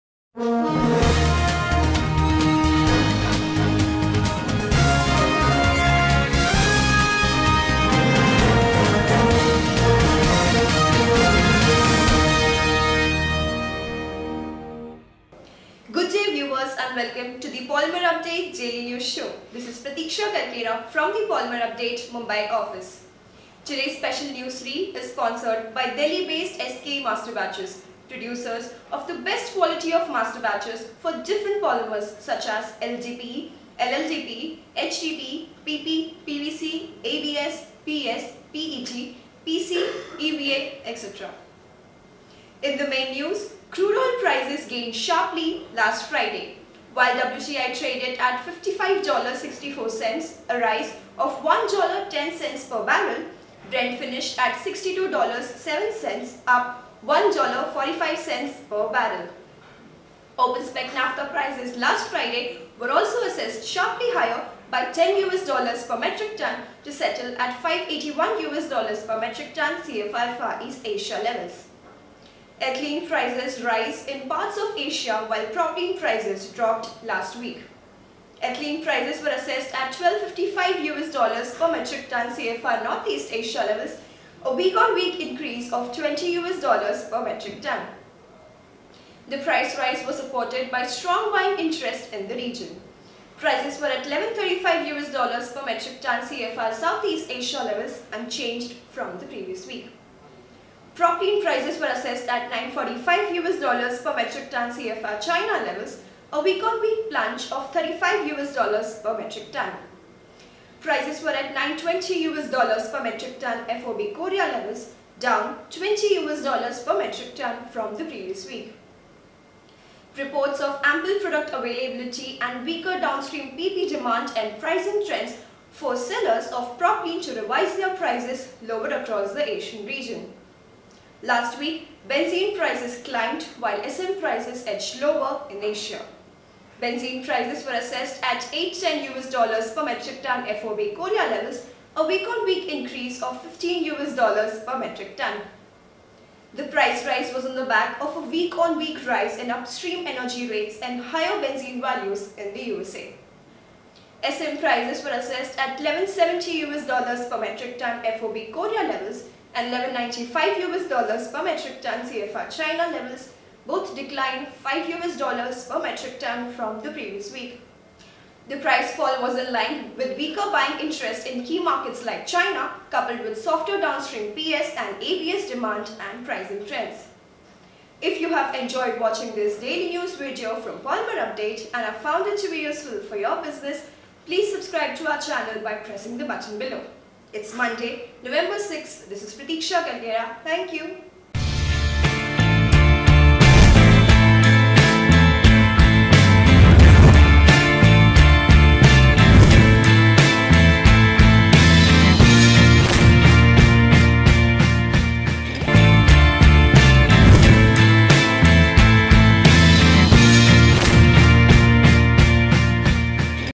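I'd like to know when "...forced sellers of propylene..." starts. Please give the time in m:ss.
2:05.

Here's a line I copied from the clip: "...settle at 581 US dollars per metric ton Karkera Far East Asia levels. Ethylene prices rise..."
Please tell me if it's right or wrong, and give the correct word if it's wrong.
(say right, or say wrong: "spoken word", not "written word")
wrong: "CFR", not "Karkera".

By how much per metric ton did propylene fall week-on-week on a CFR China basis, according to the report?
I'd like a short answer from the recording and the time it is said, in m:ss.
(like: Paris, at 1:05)
35 US dollars per metric ton, at 1:47.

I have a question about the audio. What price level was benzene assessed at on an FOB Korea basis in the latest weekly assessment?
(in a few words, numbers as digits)
810 US dollars per metric ton.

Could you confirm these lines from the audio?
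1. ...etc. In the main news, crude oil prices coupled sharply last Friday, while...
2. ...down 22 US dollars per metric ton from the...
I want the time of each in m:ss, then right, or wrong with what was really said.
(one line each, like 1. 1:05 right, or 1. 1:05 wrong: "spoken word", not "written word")
1. 0:40 wrong: "gained", not "coupled"
2. 1:55 wrong: "20", not "22".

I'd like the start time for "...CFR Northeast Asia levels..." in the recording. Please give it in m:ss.
1:22.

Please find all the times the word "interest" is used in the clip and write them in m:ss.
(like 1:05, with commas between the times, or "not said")
1:31, 2:50.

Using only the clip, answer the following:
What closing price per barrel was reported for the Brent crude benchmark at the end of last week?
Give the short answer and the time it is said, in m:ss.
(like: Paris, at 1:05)
$62.07, at 0:54.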